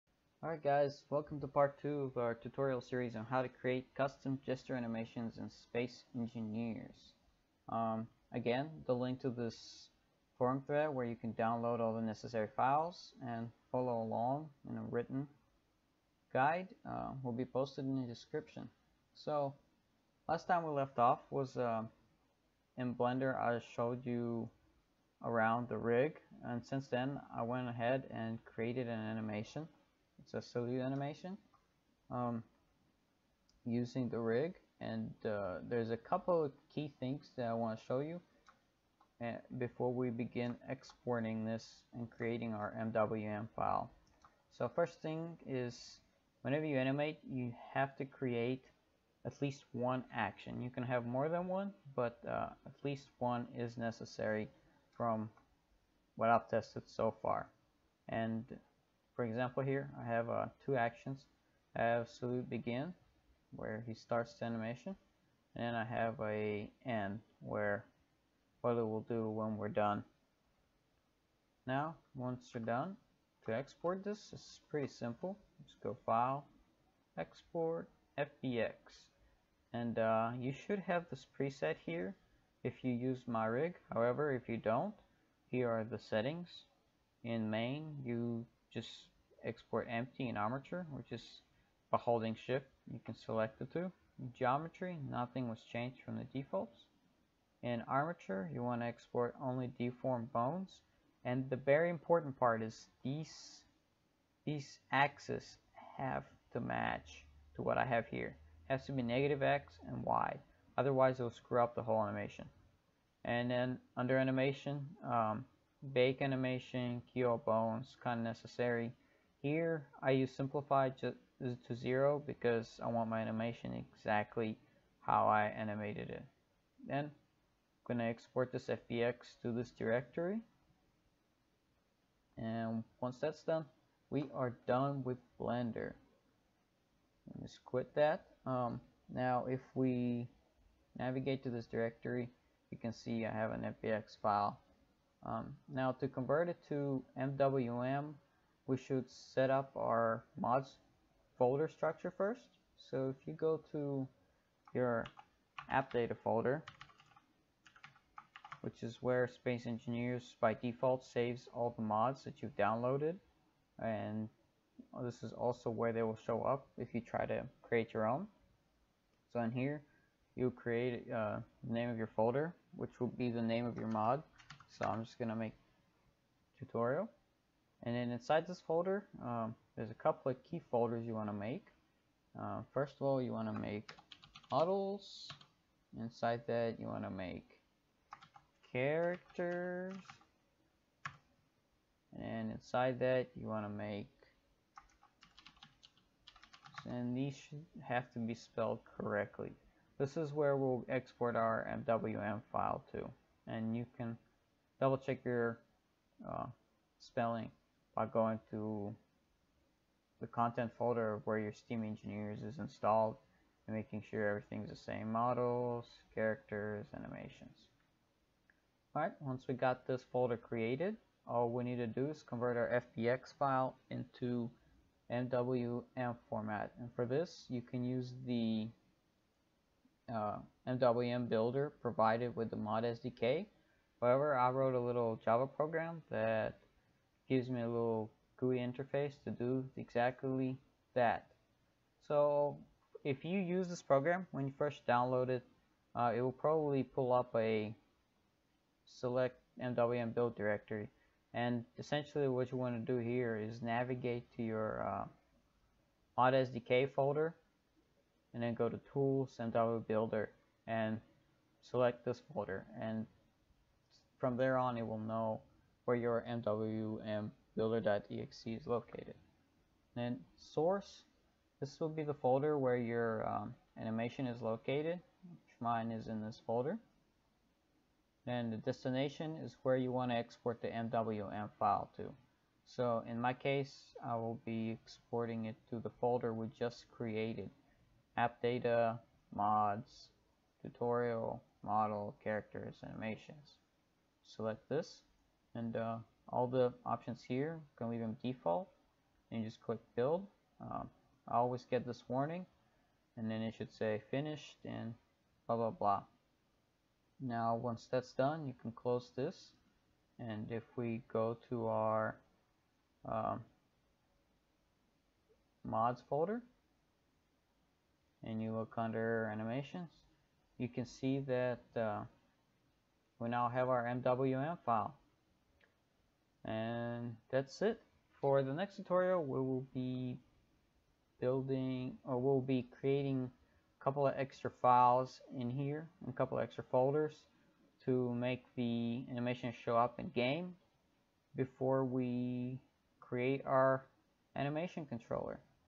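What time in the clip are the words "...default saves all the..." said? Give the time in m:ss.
2:40.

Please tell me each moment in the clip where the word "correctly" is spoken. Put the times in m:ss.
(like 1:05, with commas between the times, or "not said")
3:18.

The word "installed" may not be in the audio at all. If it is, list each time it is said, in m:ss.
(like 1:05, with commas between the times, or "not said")
3:32.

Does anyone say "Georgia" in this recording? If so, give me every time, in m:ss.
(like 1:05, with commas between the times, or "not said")
not said.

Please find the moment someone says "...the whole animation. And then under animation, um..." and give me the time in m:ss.
1:51.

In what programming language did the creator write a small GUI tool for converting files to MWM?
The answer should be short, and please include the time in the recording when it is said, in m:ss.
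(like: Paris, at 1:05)
Java, at 3:55.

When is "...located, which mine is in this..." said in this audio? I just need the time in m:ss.
4:34.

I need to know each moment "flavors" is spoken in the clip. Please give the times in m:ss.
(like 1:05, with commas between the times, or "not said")
not said.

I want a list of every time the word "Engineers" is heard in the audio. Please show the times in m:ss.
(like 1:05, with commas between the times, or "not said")
0:06, 2:39, 3:31.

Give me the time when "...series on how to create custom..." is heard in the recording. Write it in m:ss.
0:02.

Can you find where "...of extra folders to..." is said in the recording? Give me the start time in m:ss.
5:36.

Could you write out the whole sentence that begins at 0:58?
And for example, here I have uh, two actions.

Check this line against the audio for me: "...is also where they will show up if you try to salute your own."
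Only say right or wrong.
wrong.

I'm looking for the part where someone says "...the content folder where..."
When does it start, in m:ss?
3:30.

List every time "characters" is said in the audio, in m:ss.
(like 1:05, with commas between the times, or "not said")
3:08, 3:36, 4:52.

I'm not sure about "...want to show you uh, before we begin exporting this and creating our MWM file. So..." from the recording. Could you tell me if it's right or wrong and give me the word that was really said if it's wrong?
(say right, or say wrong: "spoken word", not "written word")
right.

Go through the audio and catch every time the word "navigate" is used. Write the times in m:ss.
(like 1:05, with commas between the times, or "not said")
2:20, 4:13.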